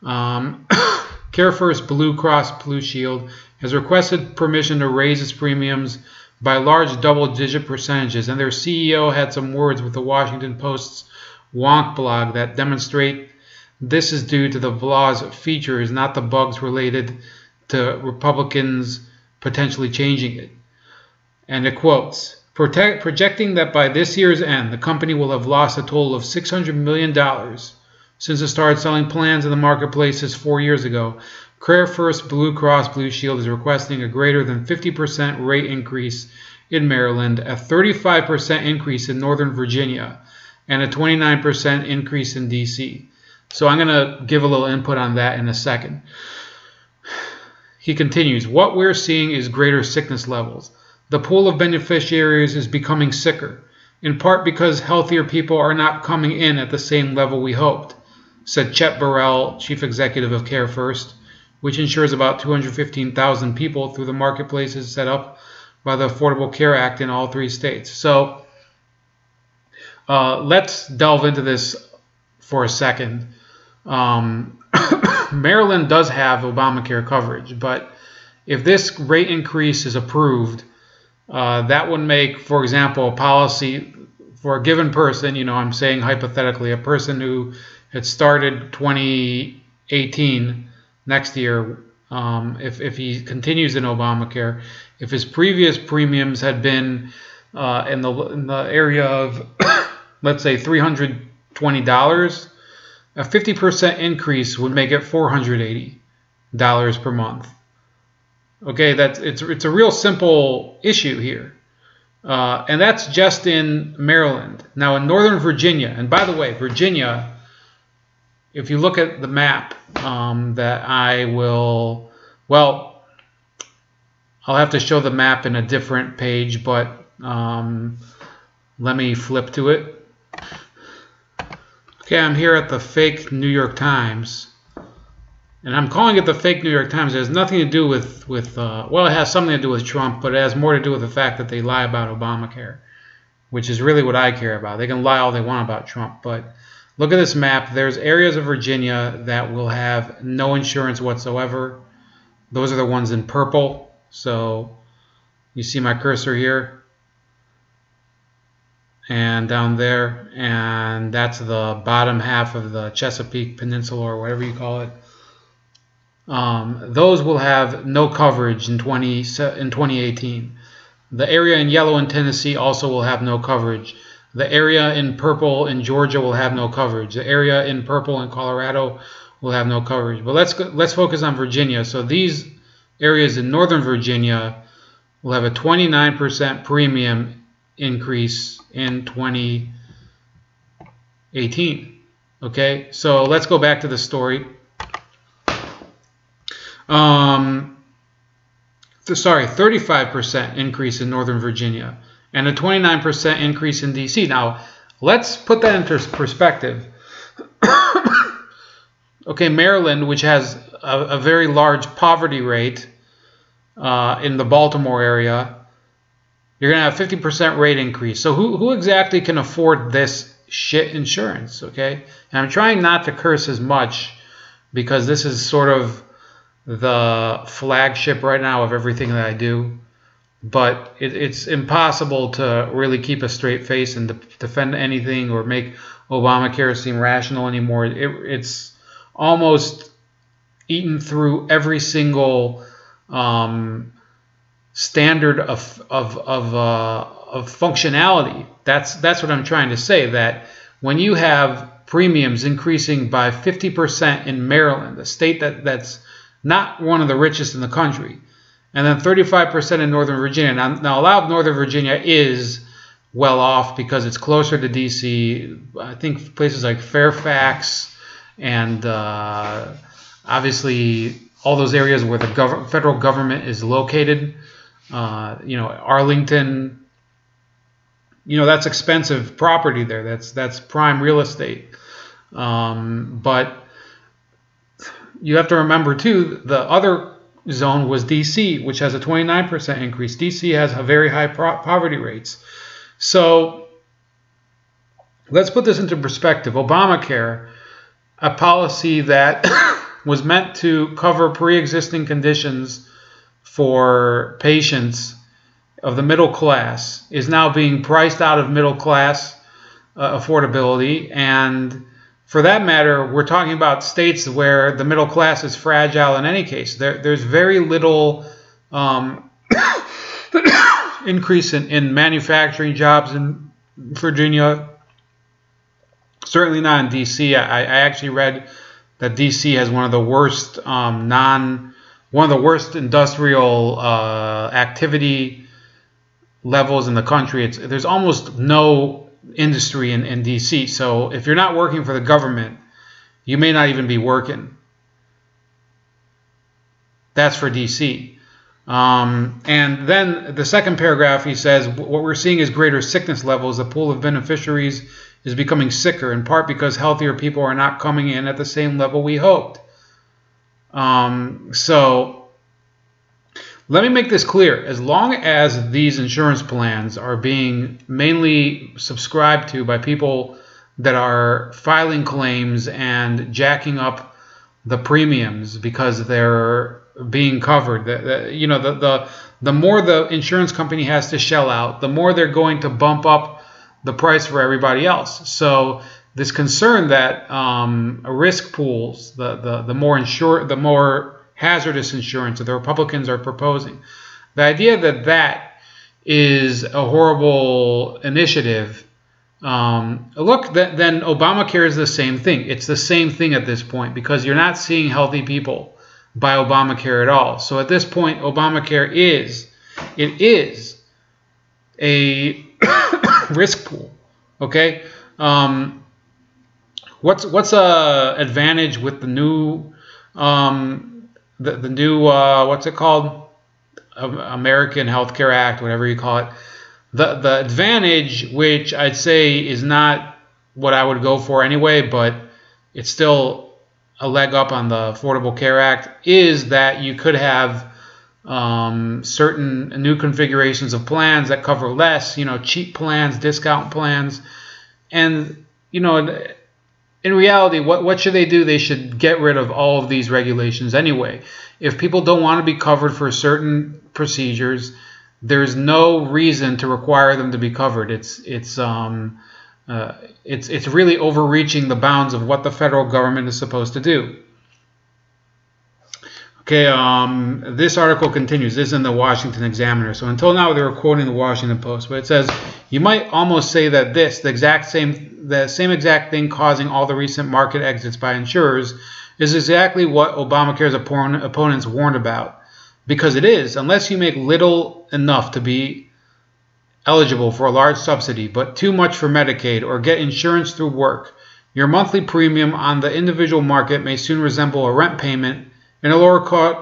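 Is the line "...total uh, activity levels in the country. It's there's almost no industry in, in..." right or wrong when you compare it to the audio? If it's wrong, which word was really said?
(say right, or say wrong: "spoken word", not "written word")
wrong: "industrial", not "total".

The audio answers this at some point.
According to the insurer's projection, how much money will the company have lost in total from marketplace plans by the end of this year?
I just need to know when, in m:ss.
0:26.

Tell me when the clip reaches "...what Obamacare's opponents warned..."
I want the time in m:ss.
7:59.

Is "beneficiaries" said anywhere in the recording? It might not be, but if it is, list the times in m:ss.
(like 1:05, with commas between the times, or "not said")
0:51, 5:53.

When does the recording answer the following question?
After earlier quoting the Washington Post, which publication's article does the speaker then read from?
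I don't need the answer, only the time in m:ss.
7:48.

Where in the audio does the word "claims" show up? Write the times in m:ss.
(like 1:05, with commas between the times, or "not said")
6:12.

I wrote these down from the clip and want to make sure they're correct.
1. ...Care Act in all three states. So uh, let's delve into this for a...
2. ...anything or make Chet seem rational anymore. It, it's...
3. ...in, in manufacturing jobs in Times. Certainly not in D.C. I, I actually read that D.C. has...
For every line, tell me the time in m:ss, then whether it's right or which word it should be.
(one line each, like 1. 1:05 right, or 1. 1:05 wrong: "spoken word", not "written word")
1. 1:06 right
2. 3:54 wrong: "Obamacare", not "Chet"
3. 5:21 wrong: "Virginia", not "Times".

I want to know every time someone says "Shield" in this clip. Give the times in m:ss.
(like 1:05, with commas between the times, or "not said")
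0:02, 0:33.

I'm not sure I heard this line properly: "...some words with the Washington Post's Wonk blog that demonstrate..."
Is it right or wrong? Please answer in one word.
right.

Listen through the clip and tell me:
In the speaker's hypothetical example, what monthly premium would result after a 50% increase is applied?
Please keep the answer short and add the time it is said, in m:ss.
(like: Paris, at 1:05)
$480, at 1:45.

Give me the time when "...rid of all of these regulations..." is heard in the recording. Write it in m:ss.
7:29.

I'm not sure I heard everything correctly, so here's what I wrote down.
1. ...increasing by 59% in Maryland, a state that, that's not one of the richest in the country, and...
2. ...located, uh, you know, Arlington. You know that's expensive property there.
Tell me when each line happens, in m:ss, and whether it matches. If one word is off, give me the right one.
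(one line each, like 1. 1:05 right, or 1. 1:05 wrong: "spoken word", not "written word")
1. 4:12 wrong: "50", not "59"
2. 4:33 right.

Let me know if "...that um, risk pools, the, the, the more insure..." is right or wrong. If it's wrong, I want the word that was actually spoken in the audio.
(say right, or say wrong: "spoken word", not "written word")
right.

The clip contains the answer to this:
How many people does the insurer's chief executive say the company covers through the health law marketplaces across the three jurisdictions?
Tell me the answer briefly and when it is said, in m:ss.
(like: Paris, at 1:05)
215,000, at 1:02.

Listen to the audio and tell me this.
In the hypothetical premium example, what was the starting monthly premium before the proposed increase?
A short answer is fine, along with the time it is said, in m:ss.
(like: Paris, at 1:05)
$320, at 1:40.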